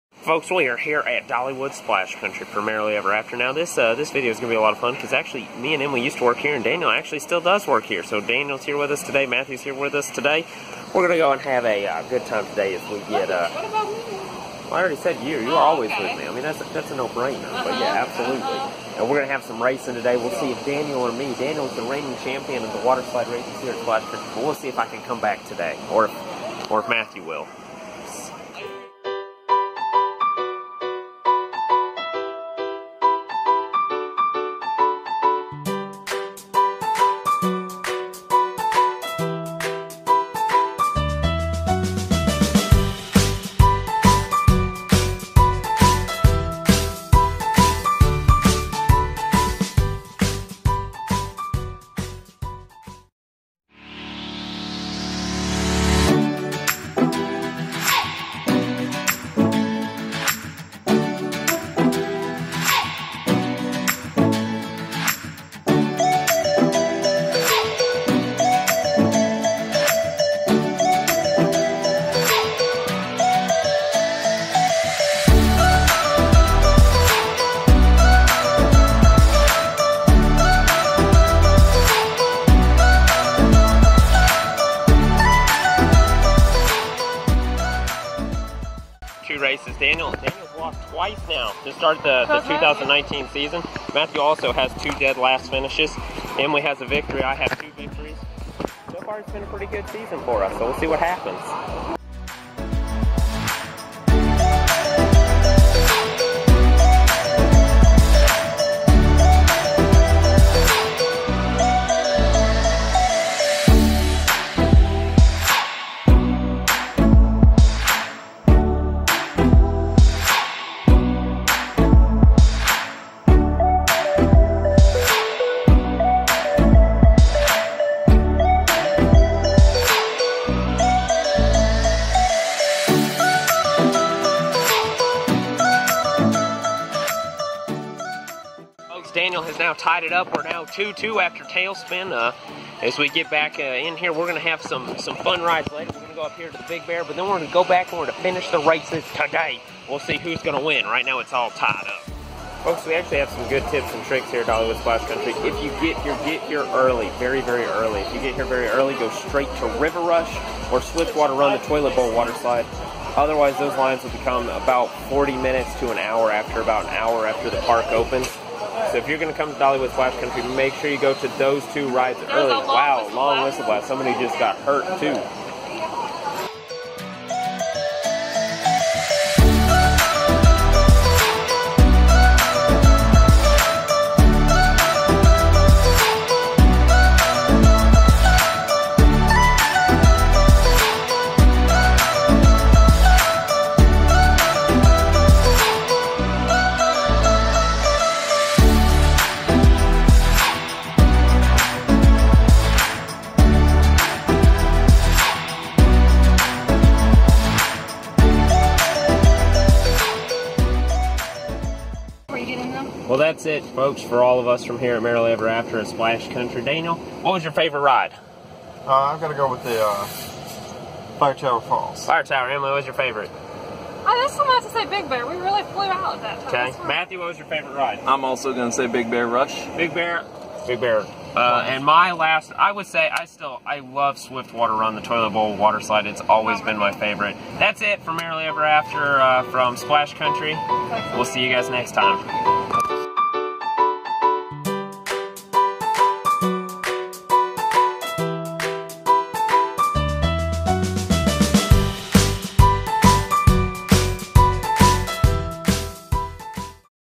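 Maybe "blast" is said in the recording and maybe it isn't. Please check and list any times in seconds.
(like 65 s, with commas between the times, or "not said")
173 s.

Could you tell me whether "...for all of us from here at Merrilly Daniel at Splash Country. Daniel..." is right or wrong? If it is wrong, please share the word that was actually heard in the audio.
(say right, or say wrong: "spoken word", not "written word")
wrong: "EverAfter", not "Daniel".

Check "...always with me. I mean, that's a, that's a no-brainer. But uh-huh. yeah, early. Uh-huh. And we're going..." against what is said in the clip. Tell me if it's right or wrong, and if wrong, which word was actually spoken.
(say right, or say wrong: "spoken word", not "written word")
wrong: "absolutely", not "early".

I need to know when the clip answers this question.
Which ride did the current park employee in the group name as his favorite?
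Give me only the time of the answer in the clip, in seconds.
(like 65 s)
221 s.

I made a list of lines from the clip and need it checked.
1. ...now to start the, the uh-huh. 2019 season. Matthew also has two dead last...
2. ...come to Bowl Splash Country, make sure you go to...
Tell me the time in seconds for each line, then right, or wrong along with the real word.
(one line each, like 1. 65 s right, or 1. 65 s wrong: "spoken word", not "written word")
1. 91 s right
2. 169 s wrong: "Dollywood", not "Bowl".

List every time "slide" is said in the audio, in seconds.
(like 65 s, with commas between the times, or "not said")
23 s, 162 s, 235 s.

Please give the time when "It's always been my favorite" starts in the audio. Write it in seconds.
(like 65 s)
236 s.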